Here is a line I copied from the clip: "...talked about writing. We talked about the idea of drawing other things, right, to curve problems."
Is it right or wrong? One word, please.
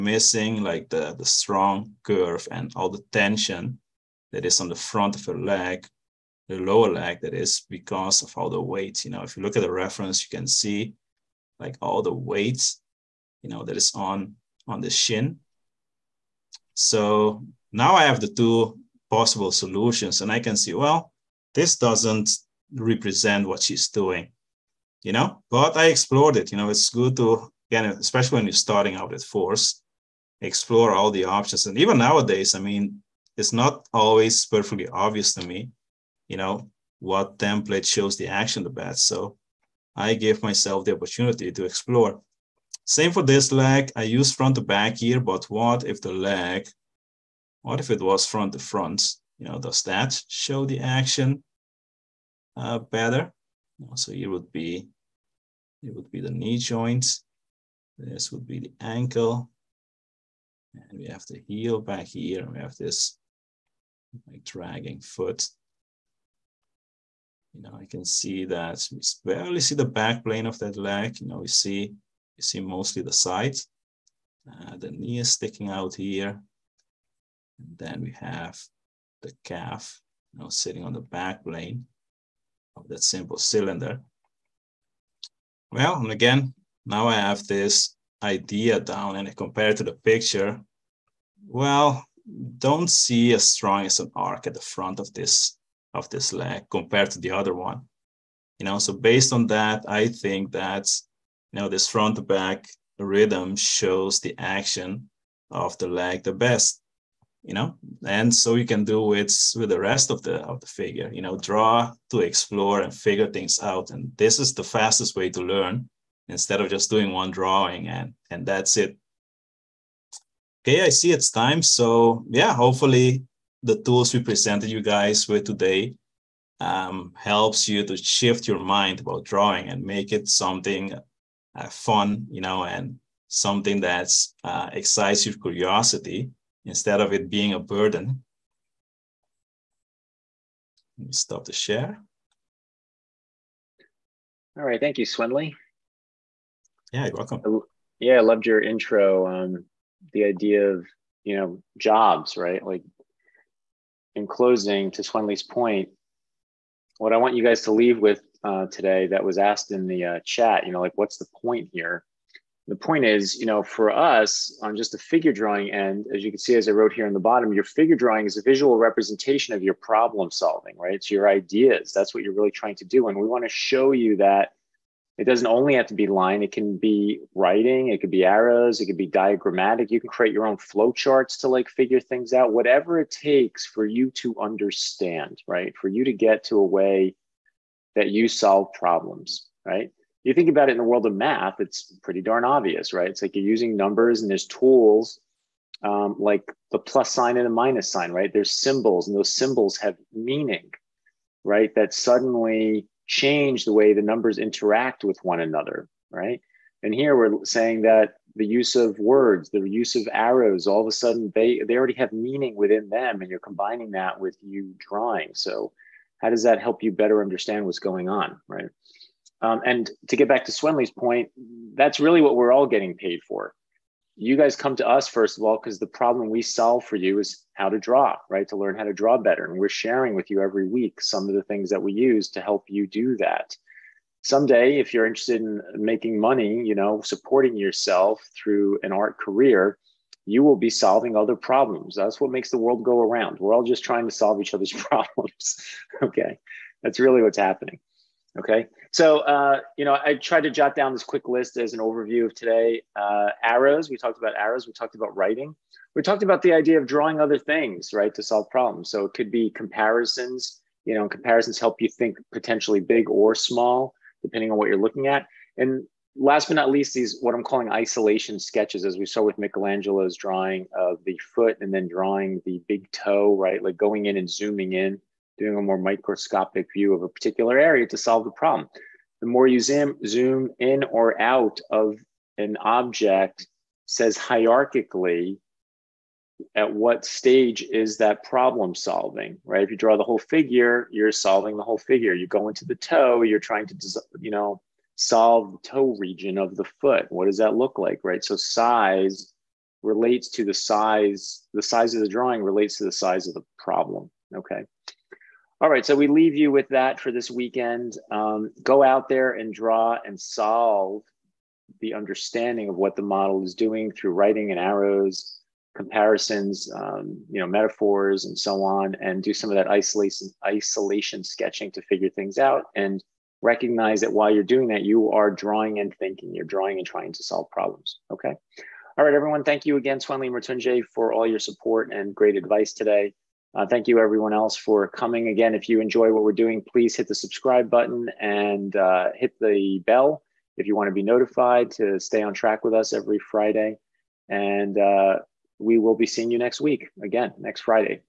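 wrong.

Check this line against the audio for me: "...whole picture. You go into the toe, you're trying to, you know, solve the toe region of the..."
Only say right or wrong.
wrong.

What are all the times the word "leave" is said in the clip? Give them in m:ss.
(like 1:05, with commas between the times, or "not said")
2:37, 5:06.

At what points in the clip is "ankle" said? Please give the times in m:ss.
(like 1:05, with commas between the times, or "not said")
0:58.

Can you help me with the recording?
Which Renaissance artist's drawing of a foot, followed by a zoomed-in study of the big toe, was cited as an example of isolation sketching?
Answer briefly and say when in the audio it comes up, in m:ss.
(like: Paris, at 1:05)
Michelangelo, at 4:29.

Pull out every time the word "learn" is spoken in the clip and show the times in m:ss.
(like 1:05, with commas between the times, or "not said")
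1:55, 3:48.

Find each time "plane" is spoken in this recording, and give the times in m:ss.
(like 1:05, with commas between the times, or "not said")
1:10, 1:21.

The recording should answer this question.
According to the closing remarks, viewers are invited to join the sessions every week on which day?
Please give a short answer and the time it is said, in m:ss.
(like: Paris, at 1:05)
Friday, at 5:43.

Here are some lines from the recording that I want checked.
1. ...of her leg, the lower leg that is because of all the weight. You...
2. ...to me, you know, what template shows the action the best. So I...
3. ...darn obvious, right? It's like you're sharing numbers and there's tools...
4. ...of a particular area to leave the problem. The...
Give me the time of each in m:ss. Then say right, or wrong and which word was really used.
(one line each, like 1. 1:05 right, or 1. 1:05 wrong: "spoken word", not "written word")
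1. 0:05 right
2. 0:35 right
3. 3:12 wrong: "using", not "sharing"
4. 4:36 wrong: "solve", not "leave".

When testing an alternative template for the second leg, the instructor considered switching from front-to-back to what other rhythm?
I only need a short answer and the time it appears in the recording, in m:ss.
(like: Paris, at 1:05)
front to front, at 0:48.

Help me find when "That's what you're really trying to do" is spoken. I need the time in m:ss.
2:51.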